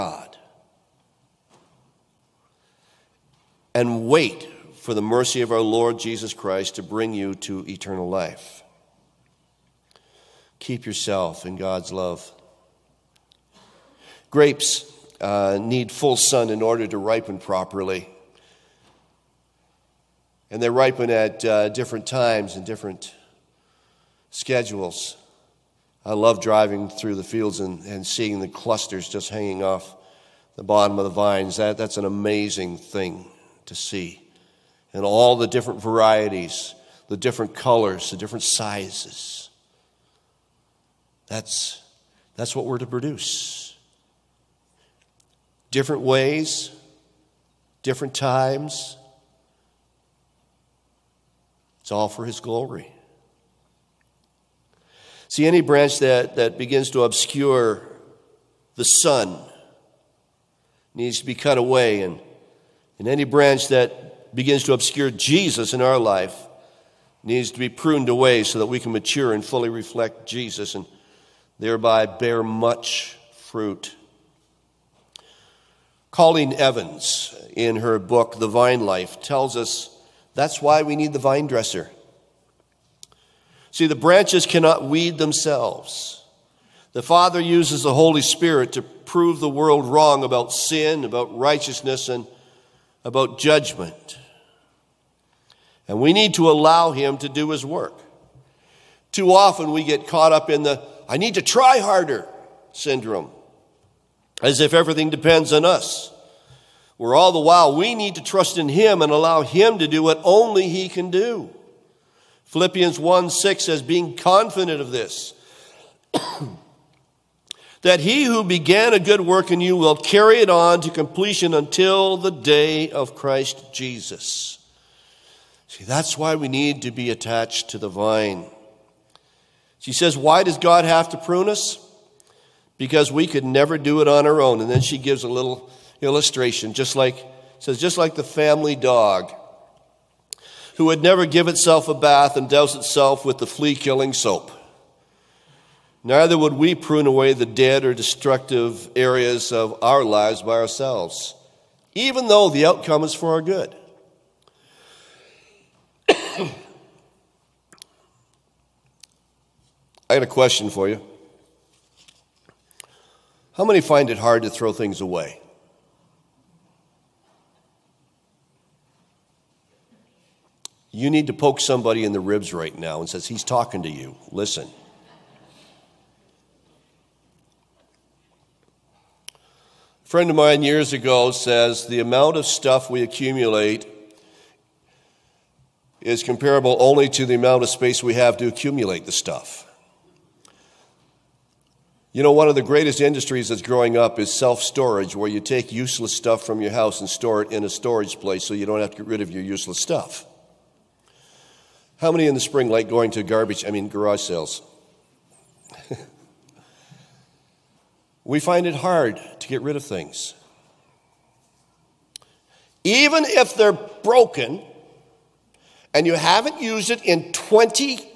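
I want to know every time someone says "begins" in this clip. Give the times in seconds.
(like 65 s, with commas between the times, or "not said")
56 s, 64 s.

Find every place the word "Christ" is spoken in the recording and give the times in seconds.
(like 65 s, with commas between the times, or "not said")
6 s, 123 s.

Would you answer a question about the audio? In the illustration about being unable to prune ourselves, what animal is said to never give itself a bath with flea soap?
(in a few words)
The family dog.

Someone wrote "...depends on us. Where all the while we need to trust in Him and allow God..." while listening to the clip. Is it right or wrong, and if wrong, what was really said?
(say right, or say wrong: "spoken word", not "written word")
wrong: "Him", not "God".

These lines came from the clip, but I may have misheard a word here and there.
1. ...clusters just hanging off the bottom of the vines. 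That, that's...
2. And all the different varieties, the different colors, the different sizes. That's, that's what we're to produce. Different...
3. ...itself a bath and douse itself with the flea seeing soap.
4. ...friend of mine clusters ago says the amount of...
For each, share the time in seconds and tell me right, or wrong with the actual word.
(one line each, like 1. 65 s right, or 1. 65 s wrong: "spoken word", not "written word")
1. 28 s right
2. 34 s right
3. 141 s wrong: "killing", not "seeing"
4. 180 s wrong: "years", not "clusters".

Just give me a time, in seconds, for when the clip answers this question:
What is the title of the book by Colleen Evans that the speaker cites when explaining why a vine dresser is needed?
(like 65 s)
78 s.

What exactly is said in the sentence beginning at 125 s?
See, that's why we need to be attached to the vine.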